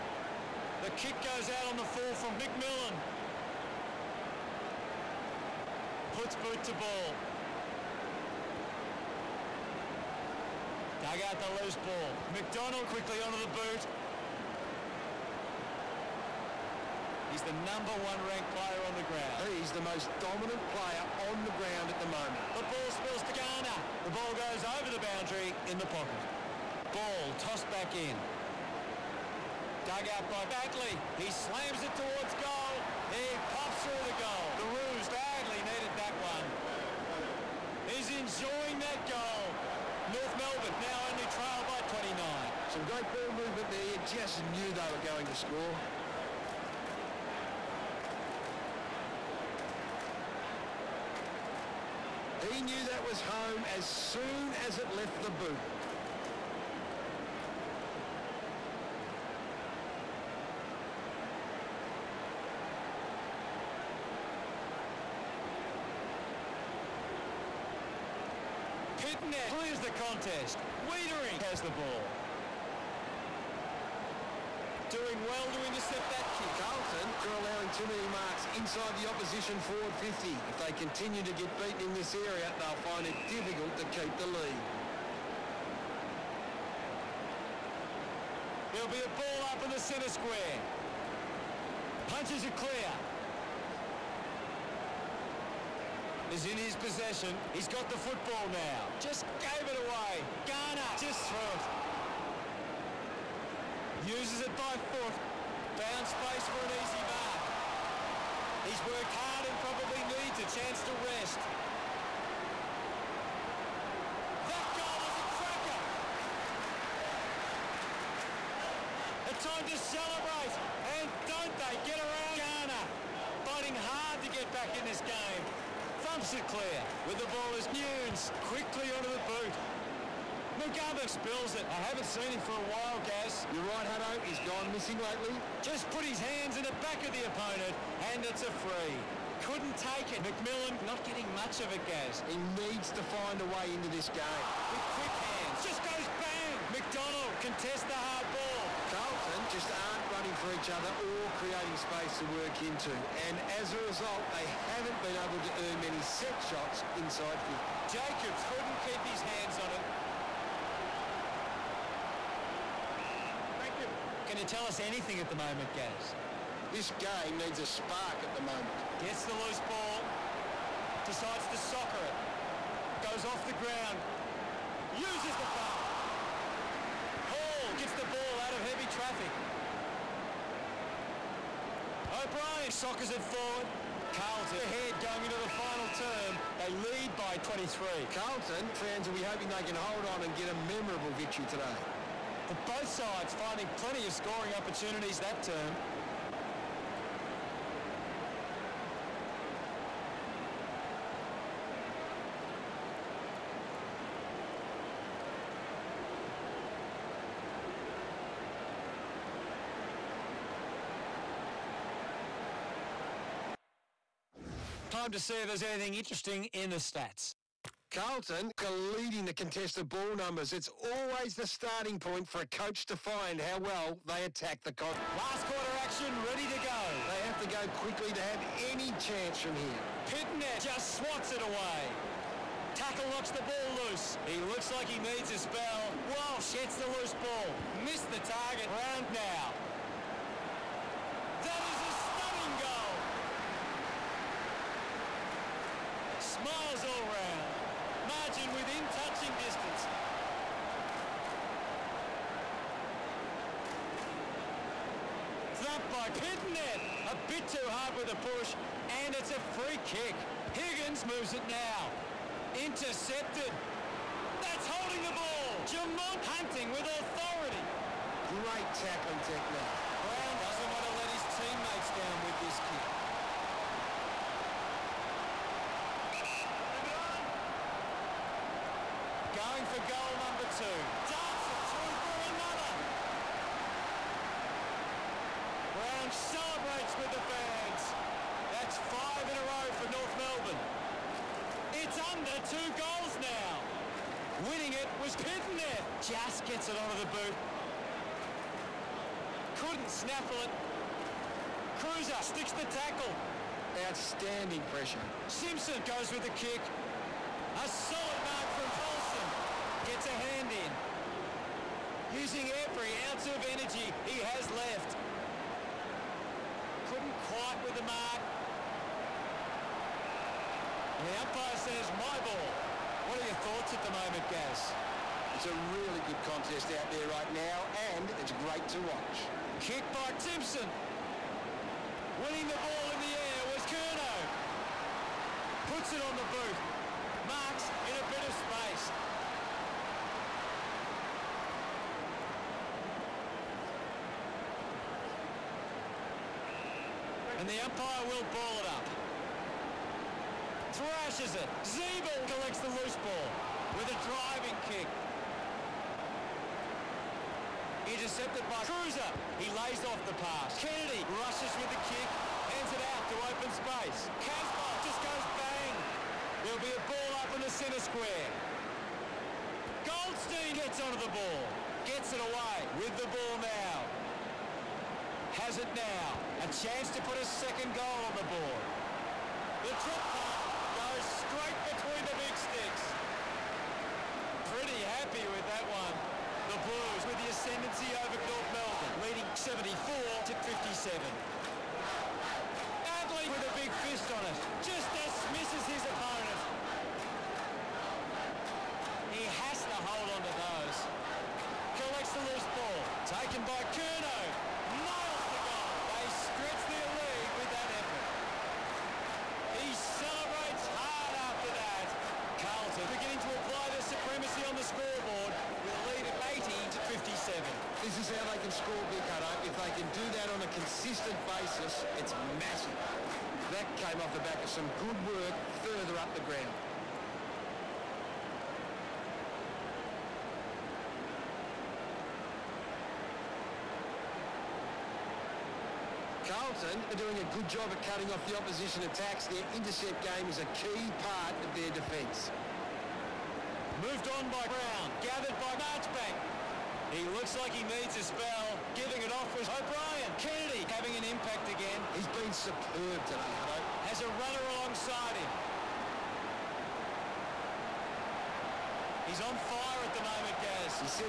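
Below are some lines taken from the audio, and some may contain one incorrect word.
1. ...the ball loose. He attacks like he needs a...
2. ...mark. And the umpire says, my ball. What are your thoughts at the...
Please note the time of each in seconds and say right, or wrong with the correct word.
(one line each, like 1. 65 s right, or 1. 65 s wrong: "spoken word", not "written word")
1. 233 s wrong: "looks", not "attacks"
2. 317 s right.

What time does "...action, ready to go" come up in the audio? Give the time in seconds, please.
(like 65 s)
225 s.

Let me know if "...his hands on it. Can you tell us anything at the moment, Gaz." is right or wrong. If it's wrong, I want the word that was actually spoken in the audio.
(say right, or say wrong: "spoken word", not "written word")
right.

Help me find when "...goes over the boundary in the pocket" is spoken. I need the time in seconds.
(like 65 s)
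24 s.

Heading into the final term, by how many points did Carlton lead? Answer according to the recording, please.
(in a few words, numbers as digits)
23.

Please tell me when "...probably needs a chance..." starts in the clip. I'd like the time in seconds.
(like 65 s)
109 s.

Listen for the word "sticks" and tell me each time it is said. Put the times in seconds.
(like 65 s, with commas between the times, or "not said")
302 s, 382 s.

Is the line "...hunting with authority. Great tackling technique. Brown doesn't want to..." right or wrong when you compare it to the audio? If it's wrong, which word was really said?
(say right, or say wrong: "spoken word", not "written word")
right.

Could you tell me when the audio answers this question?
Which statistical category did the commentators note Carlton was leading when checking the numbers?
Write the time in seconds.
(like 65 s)
219 s.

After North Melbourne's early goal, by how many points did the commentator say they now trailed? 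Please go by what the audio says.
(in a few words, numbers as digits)
29.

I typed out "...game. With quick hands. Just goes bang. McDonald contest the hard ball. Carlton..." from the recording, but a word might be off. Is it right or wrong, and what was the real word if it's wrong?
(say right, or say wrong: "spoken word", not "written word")
right.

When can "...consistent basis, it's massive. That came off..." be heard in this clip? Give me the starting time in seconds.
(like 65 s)
420 s.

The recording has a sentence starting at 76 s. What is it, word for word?
Carlton are allowing too many marks inside the opposition forward 50.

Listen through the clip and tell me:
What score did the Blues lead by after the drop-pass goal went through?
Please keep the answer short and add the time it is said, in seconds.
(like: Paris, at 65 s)
74 to 57, at 389 s.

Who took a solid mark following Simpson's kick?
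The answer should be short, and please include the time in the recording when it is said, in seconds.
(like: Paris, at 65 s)
Colson, at 308 s.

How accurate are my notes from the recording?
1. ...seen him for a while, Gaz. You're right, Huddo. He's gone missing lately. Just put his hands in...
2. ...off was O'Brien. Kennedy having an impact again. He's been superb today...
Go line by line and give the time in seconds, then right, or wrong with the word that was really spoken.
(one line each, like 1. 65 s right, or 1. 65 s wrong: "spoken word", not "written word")
1. 132 s right
2. 449 s right.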